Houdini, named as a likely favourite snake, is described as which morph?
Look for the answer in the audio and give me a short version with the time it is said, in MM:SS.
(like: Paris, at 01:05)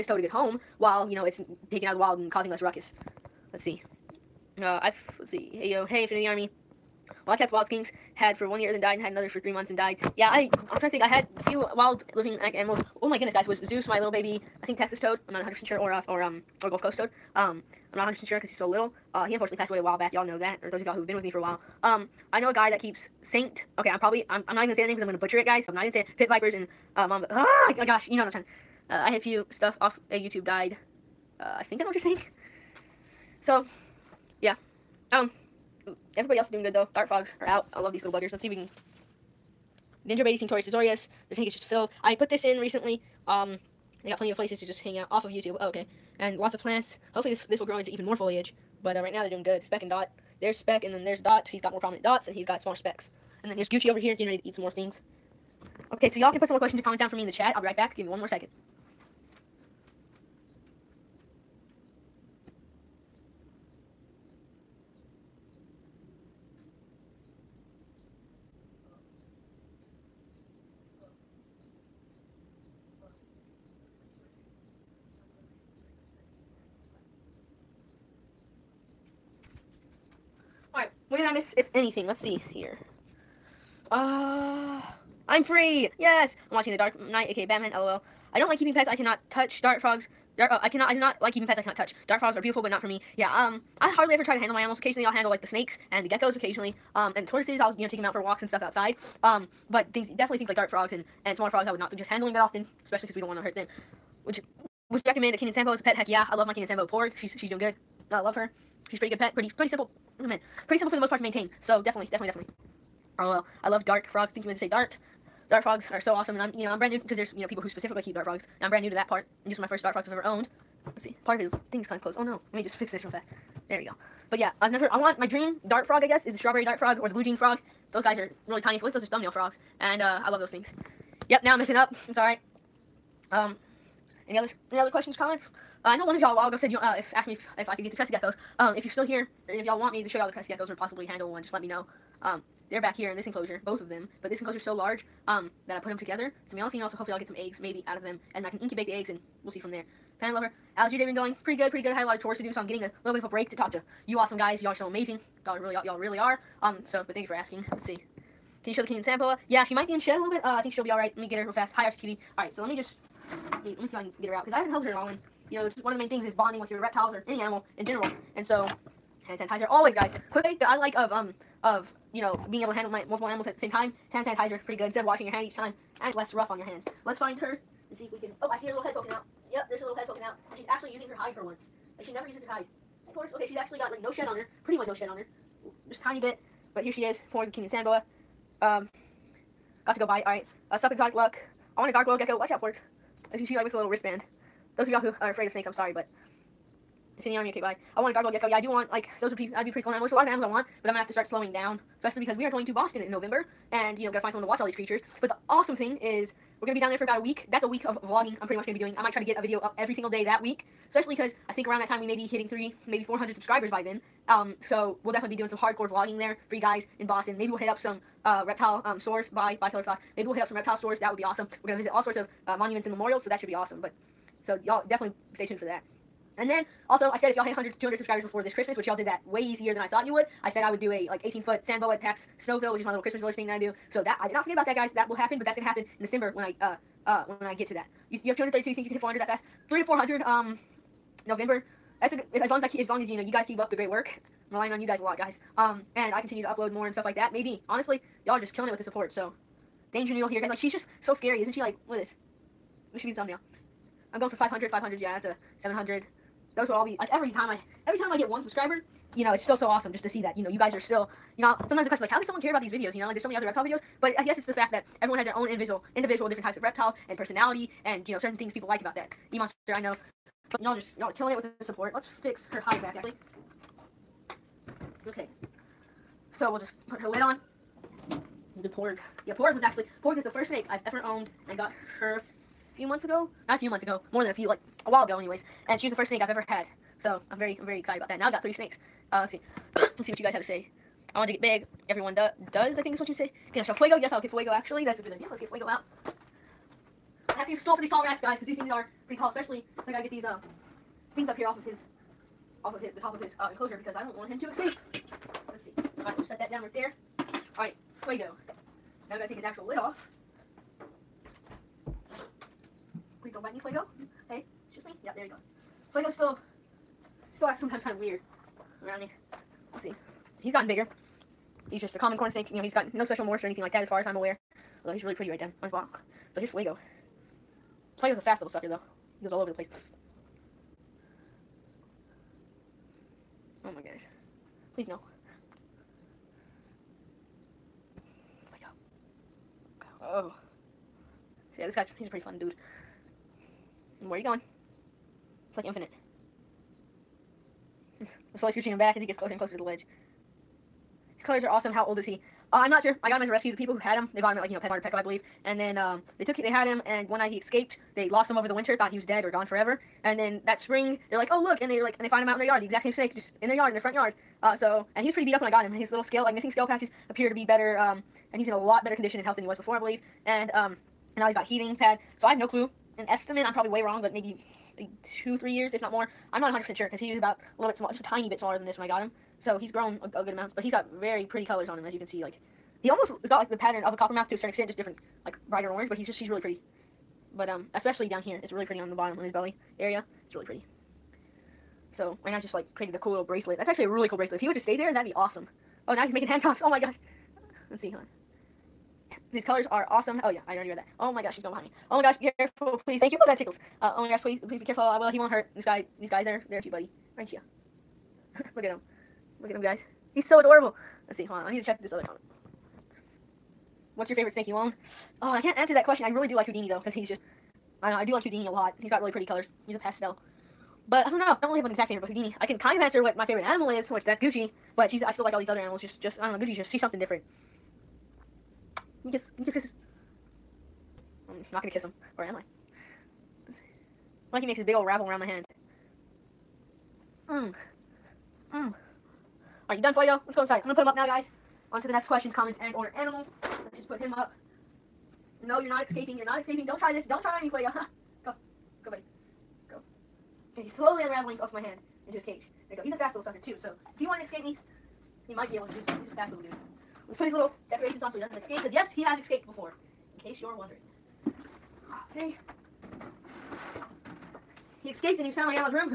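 pastel, at 06:59.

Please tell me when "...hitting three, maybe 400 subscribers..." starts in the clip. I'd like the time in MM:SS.
03:32.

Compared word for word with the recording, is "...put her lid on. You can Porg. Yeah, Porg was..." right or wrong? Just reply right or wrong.
right.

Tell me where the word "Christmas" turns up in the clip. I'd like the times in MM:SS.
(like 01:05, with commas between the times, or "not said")
03:48, 03:53.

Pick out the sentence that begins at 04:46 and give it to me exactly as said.
So I'm very, I'm very excited about that.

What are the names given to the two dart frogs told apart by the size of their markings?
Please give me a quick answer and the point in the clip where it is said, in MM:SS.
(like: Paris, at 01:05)
Speck and Dot, at 00:49.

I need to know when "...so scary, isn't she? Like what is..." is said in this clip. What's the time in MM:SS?
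04:11.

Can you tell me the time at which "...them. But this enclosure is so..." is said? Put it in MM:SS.
02:23.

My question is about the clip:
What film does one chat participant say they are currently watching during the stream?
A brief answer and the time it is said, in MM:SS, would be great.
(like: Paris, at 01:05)
The Dark Knight, at 01:26.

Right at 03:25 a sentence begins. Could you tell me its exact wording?
But the awesome thing is we're going to be down there for about a week.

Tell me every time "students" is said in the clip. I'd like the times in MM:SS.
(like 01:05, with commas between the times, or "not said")
not said.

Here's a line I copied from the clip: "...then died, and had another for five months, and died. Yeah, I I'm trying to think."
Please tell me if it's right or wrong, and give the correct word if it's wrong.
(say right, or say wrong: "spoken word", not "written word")
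wrong: "three", not "five".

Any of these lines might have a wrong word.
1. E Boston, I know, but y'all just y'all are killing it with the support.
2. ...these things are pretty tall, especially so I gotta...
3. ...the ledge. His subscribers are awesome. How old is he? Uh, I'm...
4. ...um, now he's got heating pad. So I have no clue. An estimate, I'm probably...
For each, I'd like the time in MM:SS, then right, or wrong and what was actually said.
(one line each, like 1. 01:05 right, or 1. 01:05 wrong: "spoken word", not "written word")
1. 04:29 wrong: "Monster", not "Boston"
2. 04:58 right
3. 05:49 wrong: "colors", not "subscribers"
4. 06:10 right.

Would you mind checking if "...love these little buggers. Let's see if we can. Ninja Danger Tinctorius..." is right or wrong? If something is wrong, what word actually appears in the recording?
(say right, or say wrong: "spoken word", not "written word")
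wrong: "Baby", not "Danger".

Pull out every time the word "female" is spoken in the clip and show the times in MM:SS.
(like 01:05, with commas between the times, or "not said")
02:26.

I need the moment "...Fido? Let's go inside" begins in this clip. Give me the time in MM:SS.
07:19.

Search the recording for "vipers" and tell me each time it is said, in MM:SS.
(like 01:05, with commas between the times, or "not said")
00:26.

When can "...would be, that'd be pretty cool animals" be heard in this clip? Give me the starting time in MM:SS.
03:19.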